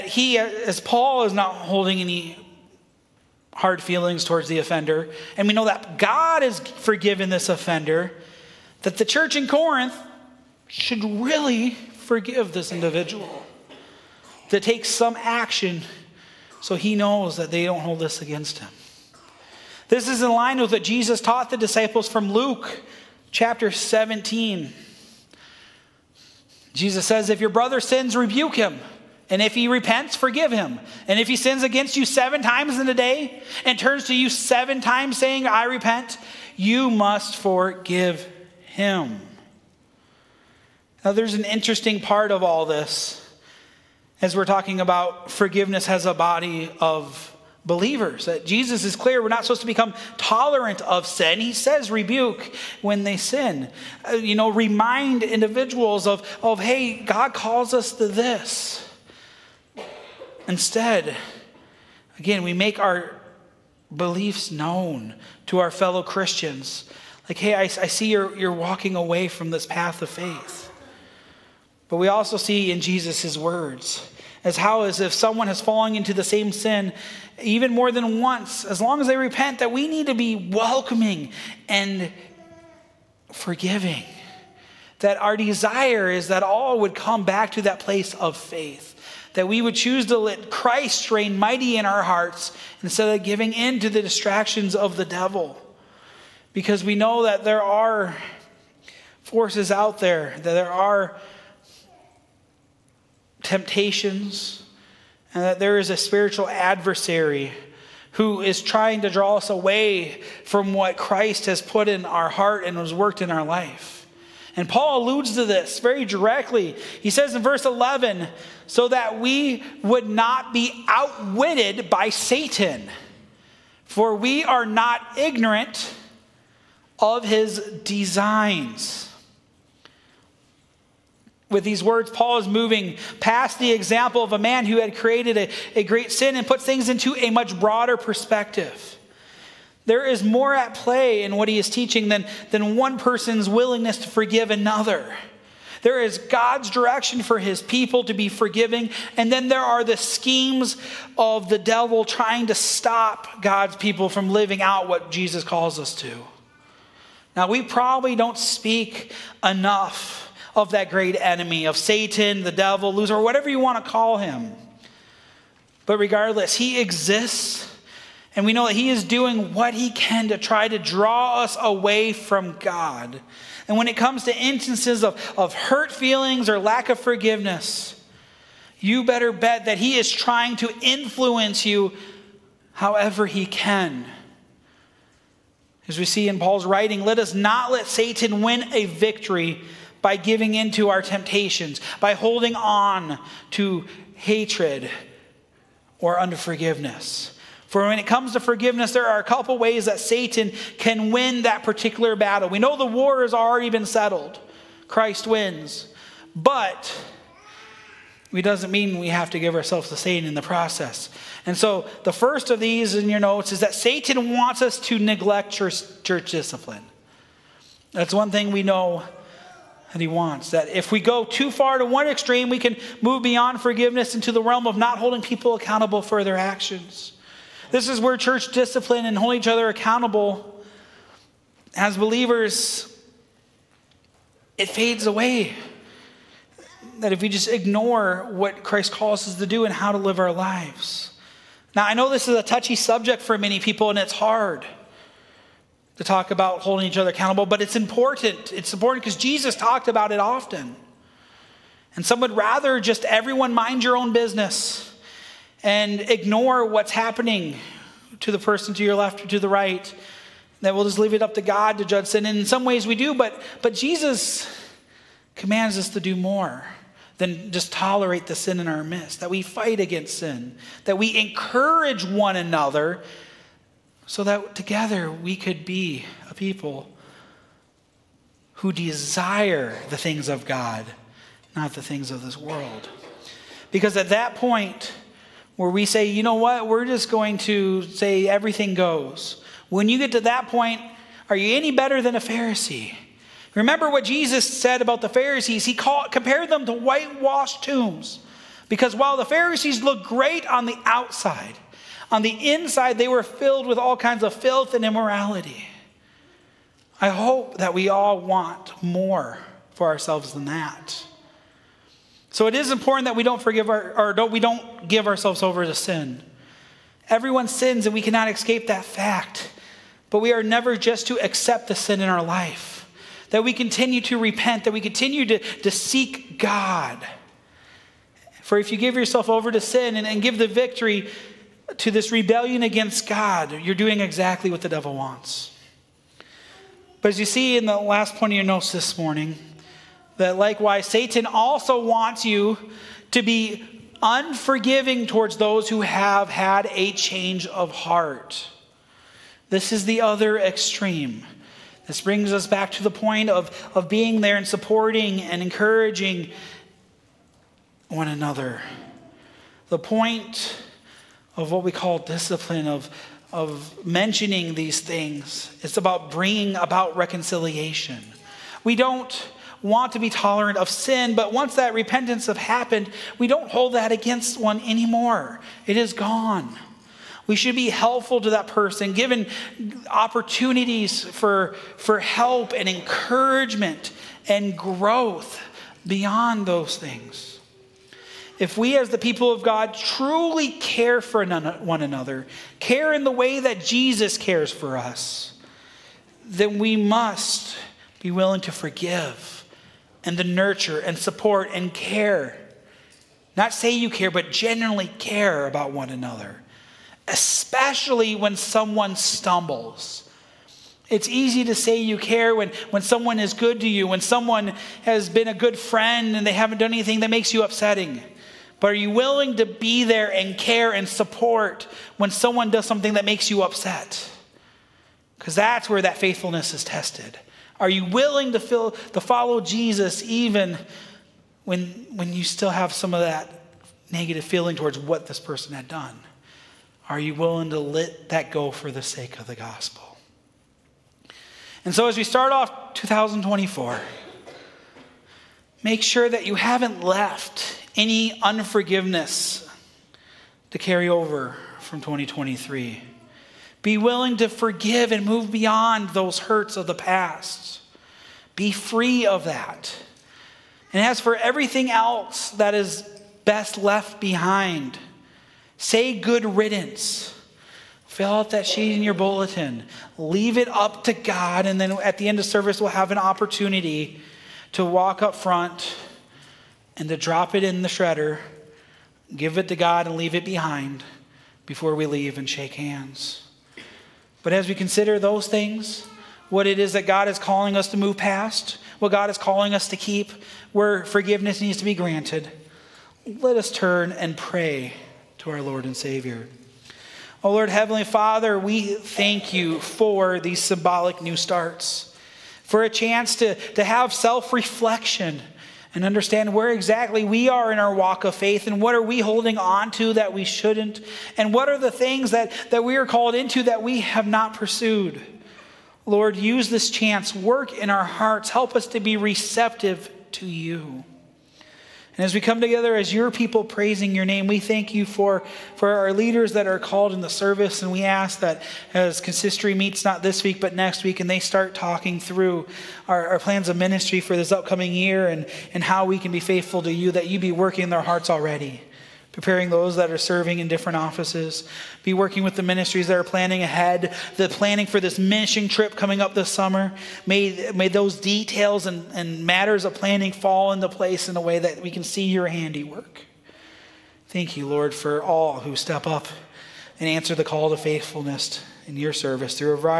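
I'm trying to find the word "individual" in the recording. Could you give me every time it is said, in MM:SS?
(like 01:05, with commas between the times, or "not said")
00:12, 00:55.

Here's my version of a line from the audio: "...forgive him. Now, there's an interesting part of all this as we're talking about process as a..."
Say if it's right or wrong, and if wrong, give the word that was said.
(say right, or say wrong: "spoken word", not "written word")
wrong: "forgiveness", not "process".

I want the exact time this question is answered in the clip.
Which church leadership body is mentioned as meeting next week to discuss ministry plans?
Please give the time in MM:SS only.
08:49.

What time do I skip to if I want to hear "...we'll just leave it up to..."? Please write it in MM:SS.
04:20.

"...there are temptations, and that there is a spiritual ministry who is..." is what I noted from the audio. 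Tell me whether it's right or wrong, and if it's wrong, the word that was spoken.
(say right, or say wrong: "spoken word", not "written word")
wrong: "adversary", not "ministry".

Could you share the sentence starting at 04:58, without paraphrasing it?
Because while the Pharisees looked great on the outside, on the inside they were filled with all kinds of filth and immorality.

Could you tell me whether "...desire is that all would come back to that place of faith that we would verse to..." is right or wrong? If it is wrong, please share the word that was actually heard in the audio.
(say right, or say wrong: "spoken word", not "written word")
wrong: "choose", not "verse".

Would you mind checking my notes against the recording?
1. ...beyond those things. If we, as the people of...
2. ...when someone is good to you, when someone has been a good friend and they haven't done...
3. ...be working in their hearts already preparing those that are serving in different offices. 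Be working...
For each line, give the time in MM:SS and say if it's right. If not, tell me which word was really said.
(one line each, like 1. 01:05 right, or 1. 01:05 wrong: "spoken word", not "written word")
1. 06:25 right
2. 06:52 right
3. 08:57 right.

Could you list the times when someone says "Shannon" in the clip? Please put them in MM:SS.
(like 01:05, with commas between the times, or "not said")
not said.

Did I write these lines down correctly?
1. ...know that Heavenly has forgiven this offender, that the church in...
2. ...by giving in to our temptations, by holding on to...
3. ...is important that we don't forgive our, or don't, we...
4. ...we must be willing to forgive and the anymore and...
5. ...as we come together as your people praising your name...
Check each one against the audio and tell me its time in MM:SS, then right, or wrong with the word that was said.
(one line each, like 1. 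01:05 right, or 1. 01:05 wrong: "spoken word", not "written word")
1. 00:05 wrong: "God", not "Heavenly"
2. 03:10 right
3. 05:12 right
4. 06:36 wrong: "nurture", not "anymore"
5. 08:42 right.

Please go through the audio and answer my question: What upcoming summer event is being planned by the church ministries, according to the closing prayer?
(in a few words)
mission trip.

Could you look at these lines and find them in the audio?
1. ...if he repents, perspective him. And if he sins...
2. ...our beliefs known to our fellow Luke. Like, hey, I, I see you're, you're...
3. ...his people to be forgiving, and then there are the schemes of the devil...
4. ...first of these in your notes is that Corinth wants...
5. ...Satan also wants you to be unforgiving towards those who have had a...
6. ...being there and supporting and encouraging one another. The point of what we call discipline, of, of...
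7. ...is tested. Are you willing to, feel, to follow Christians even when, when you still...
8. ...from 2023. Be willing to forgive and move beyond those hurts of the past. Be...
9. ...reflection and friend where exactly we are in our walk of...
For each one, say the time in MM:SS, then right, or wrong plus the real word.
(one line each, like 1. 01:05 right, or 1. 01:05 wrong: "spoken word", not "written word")
1. 00:29 wrong: "forgive", not "perspective"
2. 01:02 wrong: "Christians", not "Luke"
3. 02:27 right
4. 03:32 wrong: "Satan", not "Corinth"
5. 05:40 right
6. 05:53 right
7. 07:06 wrong: "Jesus", not "Christians"
8. 07:31 right
9. 08:24 wrong: "understand", not "friend".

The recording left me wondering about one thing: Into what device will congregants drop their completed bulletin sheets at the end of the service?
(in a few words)
the shredder.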